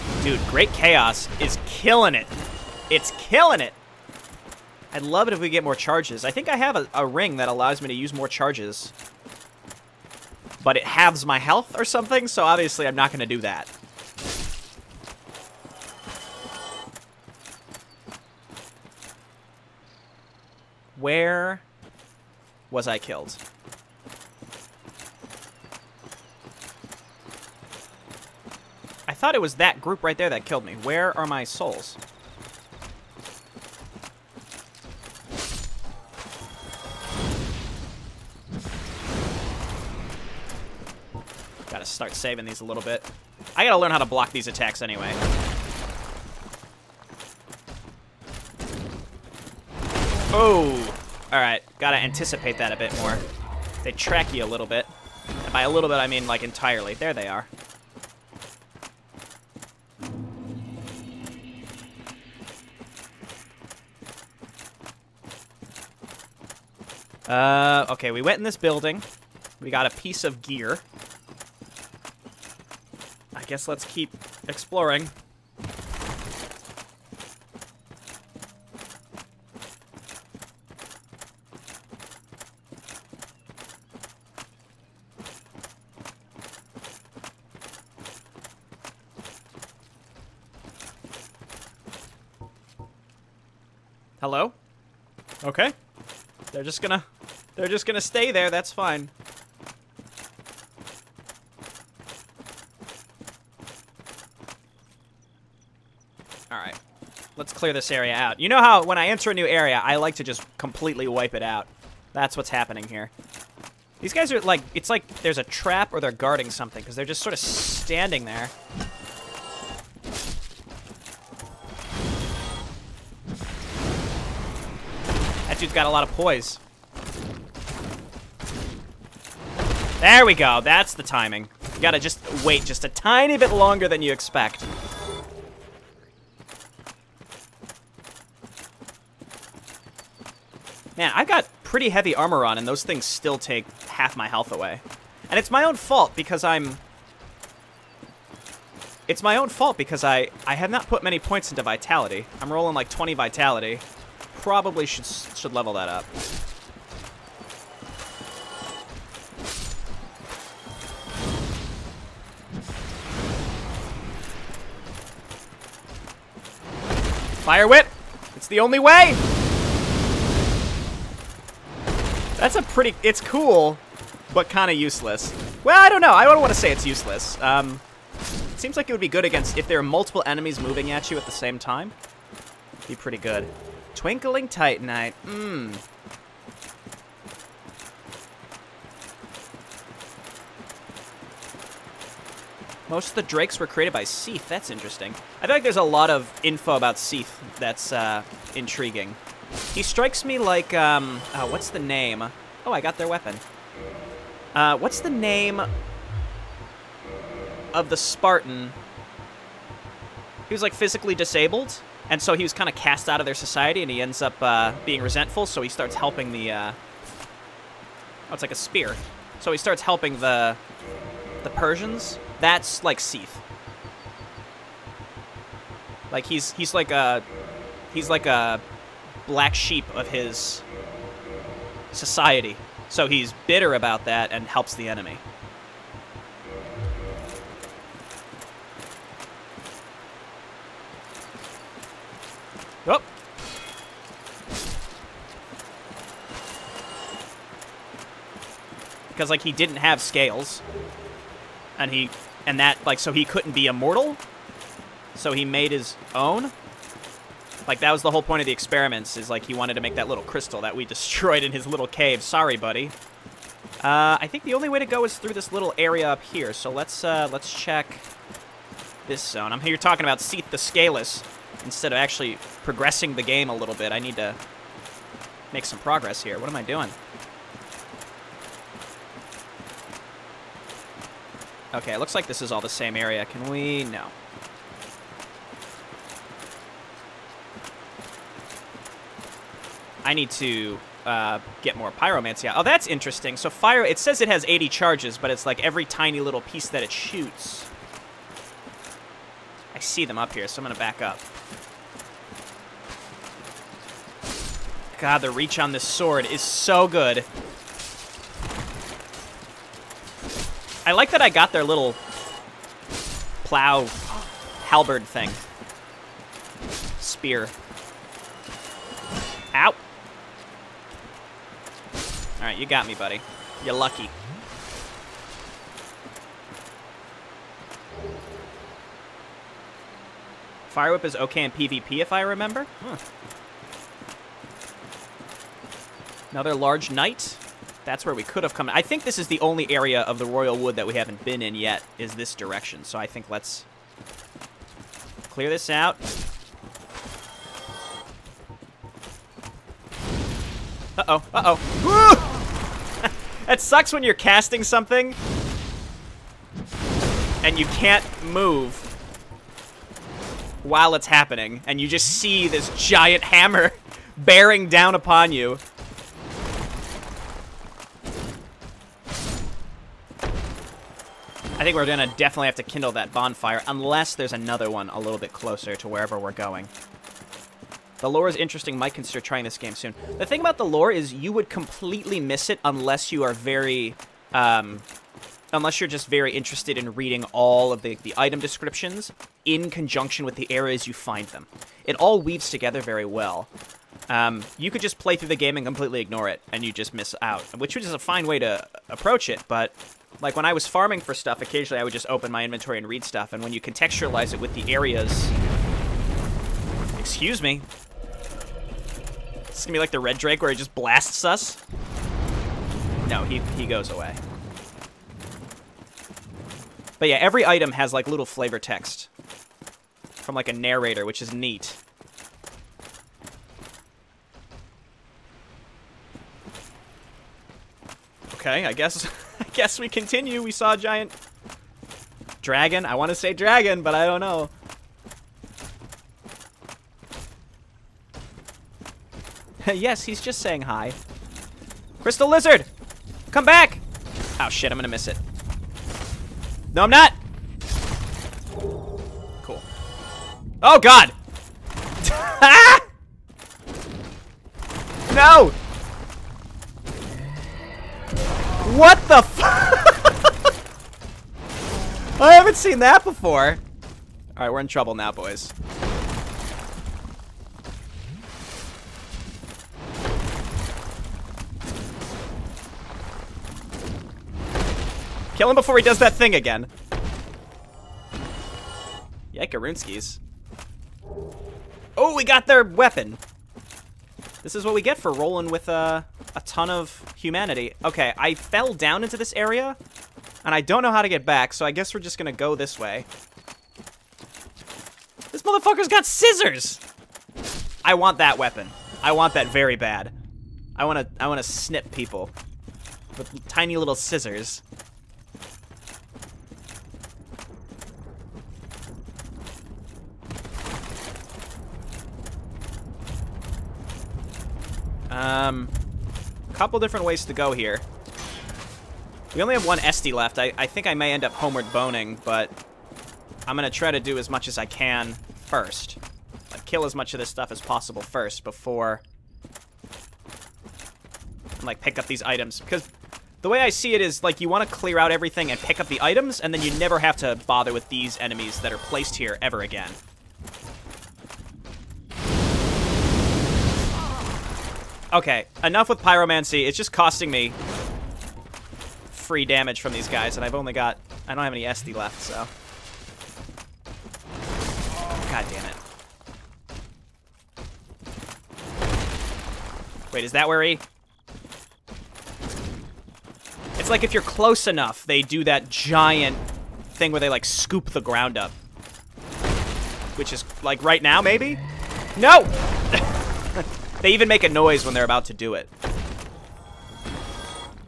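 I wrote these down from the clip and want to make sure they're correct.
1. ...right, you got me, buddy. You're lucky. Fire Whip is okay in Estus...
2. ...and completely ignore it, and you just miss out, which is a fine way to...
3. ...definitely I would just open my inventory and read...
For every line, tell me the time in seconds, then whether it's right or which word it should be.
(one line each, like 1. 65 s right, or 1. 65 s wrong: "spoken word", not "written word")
1. 322 s wrong: "PvP", not "Estus"
2. 395 s right
3. 401 s wrong: "occasionally", not "definitely".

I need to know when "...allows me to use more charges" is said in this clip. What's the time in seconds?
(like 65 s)
7 s.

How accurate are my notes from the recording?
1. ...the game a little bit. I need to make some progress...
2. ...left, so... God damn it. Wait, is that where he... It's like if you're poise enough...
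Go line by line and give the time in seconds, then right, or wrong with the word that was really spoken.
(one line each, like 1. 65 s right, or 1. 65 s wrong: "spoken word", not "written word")
1. 273 s right
2. 551 s wrong: "close", not "poise".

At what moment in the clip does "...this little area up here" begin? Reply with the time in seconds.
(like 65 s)
265 s.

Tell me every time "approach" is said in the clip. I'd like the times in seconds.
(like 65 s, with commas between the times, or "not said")
398 s.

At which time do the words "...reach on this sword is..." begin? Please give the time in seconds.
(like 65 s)
305 s.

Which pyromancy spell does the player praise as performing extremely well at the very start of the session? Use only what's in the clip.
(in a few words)
Great Chaos.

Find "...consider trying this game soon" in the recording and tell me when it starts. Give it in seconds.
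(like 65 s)
378 s.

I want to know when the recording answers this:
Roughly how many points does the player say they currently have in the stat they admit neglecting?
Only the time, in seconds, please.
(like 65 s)
152 s.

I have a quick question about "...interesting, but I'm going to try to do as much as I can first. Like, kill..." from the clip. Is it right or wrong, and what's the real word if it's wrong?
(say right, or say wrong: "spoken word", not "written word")
wrong: "boning", not "interesting".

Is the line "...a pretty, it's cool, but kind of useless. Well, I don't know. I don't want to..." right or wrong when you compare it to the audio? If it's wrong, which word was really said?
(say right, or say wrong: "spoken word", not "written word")
right.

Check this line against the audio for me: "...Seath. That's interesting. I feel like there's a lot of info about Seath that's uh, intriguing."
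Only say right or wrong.
right.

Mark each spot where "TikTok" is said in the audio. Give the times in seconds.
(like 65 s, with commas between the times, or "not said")
not said.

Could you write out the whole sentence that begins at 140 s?
Man, I've got pretty heavy armor on, and those things still take half my health away.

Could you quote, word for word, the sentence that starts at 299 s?
I see them up here, so I'm going to back up.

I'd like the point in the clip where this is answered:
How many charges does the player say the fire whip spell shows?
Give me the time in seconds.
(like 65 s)
294 s.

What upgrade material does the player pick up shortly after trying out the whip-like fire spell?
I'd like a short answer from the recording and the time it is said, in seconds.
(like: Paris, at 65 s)
Twinkling Titanite, at 183 s.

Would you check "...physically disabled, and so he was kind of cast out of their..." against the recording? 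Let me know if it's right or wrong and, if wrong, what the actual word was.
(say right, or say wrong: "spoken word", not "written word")
right.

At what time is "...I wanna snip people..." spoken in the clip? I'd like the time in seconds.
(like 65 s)
501 s.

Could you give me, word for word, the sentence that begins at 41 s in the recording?
Gotta start saving these a little bit.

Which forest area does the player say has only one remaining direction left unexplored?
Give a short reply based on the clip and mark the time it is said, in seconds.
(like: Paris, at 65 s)
the Royal Wood, at 340 s.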